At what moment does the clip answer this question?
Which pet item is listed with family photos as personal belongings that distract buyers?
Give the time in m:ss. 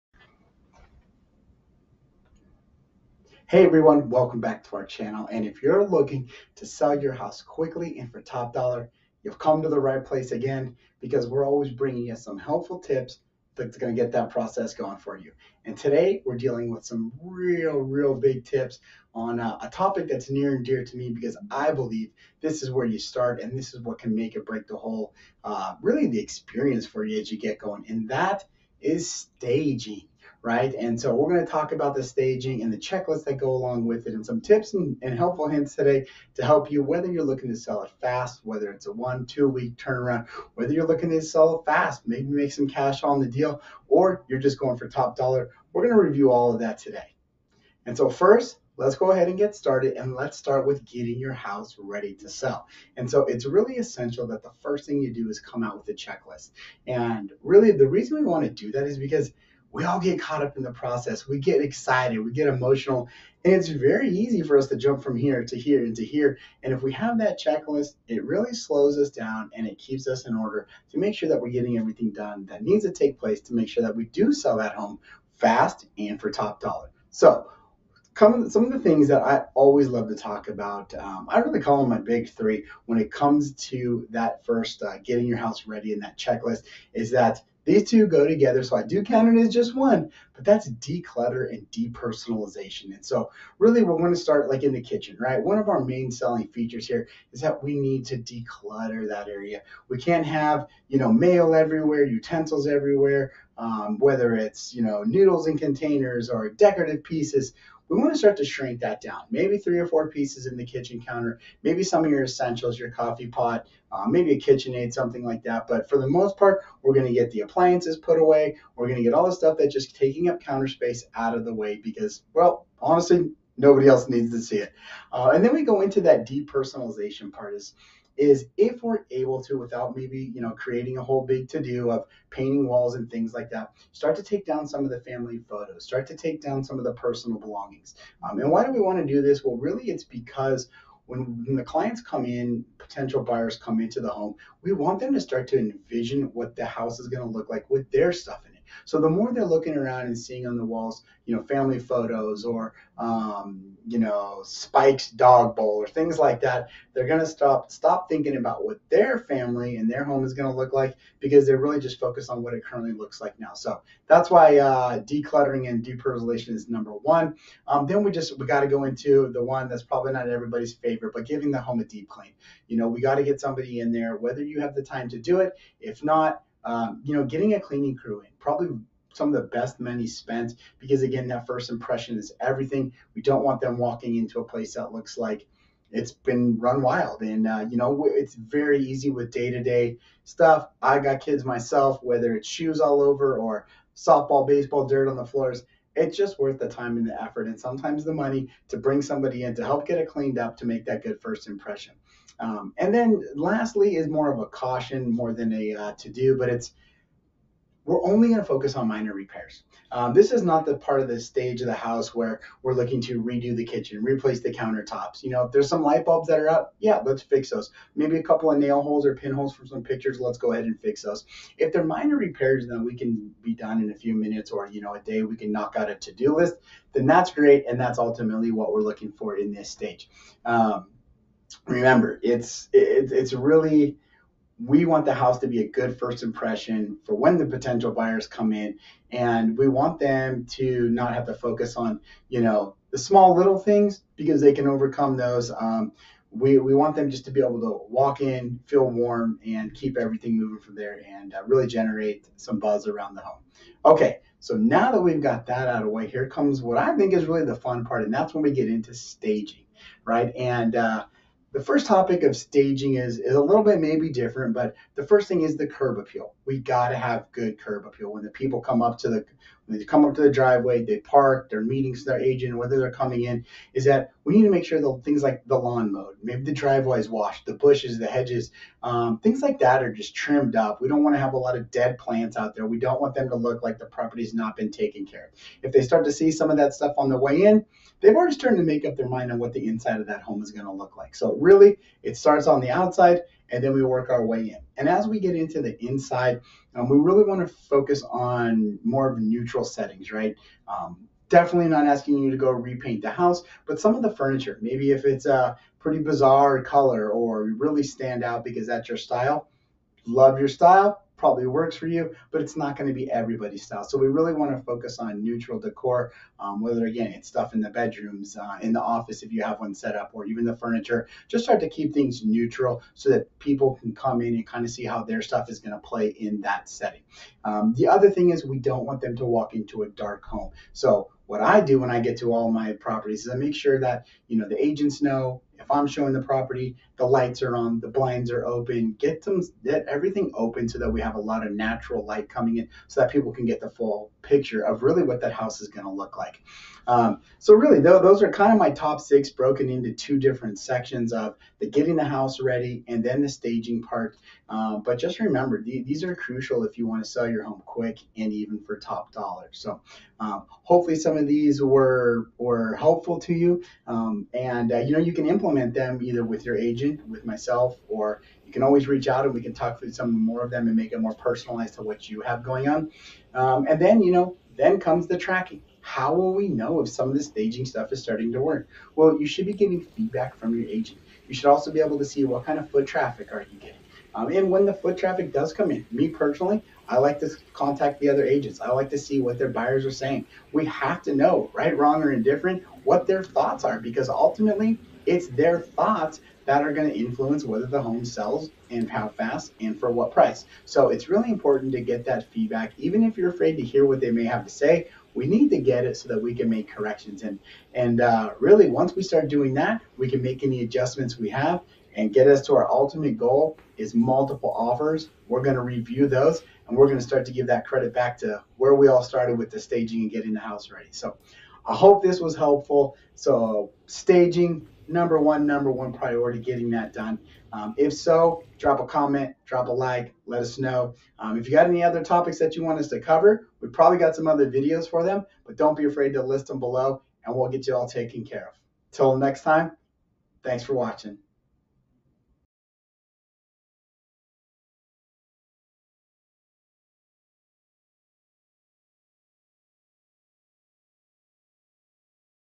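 2:35.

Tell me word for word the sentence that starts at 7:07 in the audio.
Um, if so, drop a comment, drop a like, let us know.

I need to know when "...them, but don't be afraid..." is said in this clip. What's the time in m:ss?
7:15.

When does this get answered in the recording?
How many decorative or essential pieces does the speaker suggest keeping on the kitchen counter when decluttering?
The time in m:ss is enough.
1:49.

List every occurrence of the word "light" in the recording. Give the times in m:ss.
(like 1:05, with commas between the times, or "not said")
3:35, 5:37, 5:42.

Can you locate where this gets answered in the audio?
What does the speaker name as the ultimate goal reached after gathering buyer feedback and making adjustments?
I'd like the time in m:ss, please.
6:53.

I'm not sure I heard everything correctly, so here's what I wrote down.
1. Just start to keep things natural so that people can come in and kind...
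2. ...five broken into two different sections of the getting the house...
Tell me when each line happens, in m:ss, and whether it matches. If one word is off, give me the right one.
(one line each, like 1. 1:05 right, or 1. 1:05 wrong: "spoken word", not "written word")
1. 5:21 wrong: "neutral", not "natural"
2. 5:48 wrong: "six", not "five".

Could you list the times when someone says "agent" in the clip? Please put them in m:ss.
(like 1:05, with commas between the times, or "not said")
4:32, 5:34, 6:06, 6:20, 6:28.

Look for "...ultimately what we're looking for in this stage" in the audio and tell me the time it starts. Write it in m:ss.
3:47.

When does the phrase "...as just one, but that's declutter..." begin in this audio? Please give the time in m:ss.
1:29.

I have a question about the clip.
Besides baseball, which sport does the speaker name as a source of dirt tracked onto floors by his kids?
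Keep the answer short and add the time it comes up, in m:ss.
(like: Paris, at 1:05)
Softball, at 3:13.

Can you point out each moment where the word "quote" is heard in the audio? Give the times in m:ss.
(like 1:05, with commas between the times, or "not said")
not said.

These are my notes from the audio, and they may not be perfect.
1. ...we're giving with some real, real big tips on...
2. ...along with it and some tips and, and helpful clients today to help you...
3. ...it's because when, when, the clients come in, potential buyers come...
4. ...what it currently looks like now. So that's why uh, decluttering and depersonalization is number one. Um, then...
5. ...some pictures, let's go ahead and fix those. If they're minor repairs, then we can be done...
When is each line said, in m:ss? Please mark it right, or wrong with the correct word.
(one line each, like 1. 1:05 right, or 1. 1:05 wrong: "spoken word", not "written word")
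1. 0:16 wrong: "dealing", not "giving"
2. 0:33 wrong: "hints", not "clients"
3. 2:19 right
4. 2:42 right
5. 3:39 right.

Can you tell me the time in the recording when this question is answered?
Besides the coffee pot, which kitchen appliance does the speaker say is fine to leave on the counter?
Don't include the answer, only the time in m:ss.
1:54.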